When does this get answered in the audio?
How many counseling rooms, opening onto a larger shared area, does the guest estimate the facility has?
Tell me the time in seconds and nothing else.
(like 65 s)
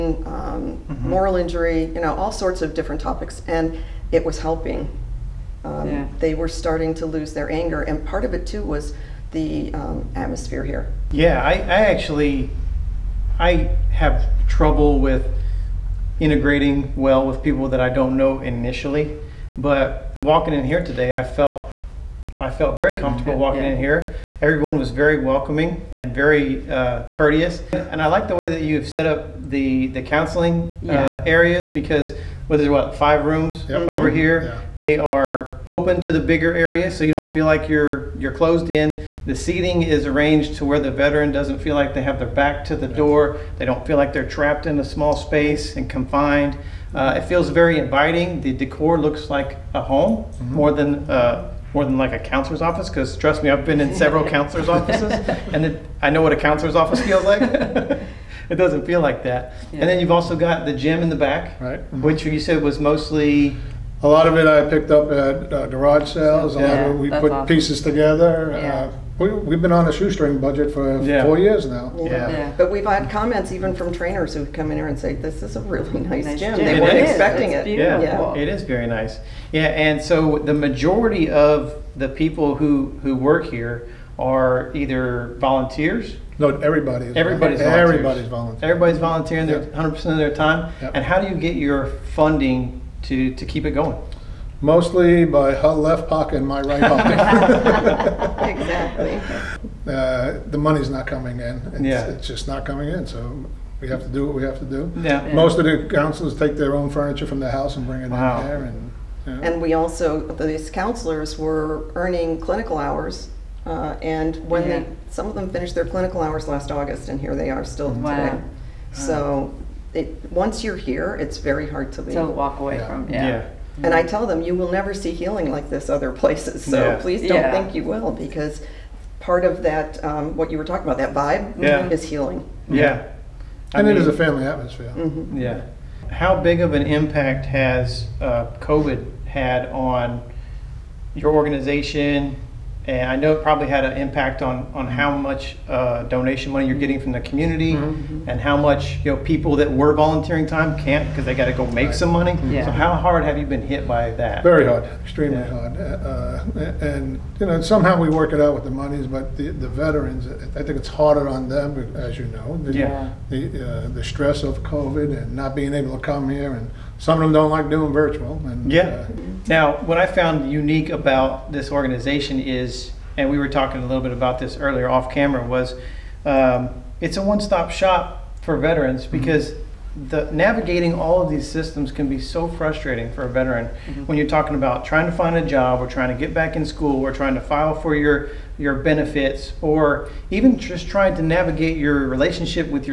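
32 s.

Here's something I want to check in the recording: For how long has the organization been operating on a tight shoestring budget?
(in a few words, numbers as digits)
4 years.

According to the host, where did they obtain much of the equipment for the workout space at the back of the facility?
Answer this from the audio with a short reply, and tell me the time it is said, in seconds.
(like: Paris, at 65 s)
garage sales, at 65 s.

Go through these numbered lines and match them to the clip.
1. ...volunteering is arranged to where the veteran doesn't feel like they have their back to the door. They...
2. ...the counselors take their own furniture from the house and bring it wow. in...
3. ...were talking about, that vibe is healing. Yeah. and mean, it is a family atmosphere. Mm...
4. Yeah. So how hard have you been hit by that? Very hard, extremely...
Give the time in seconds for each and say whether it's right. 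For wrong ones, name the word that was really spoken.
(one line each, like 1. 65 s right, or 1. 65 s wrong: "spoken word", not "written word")
1. 39 s wrong: "seating", not "volunteering"
2. 105 s right
3. 130 s right
4. 152 s right.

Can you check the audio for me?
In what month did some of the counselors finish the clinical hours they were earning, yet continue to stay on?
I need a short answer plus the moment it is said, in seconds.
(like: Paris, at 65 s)
August, at 116 s.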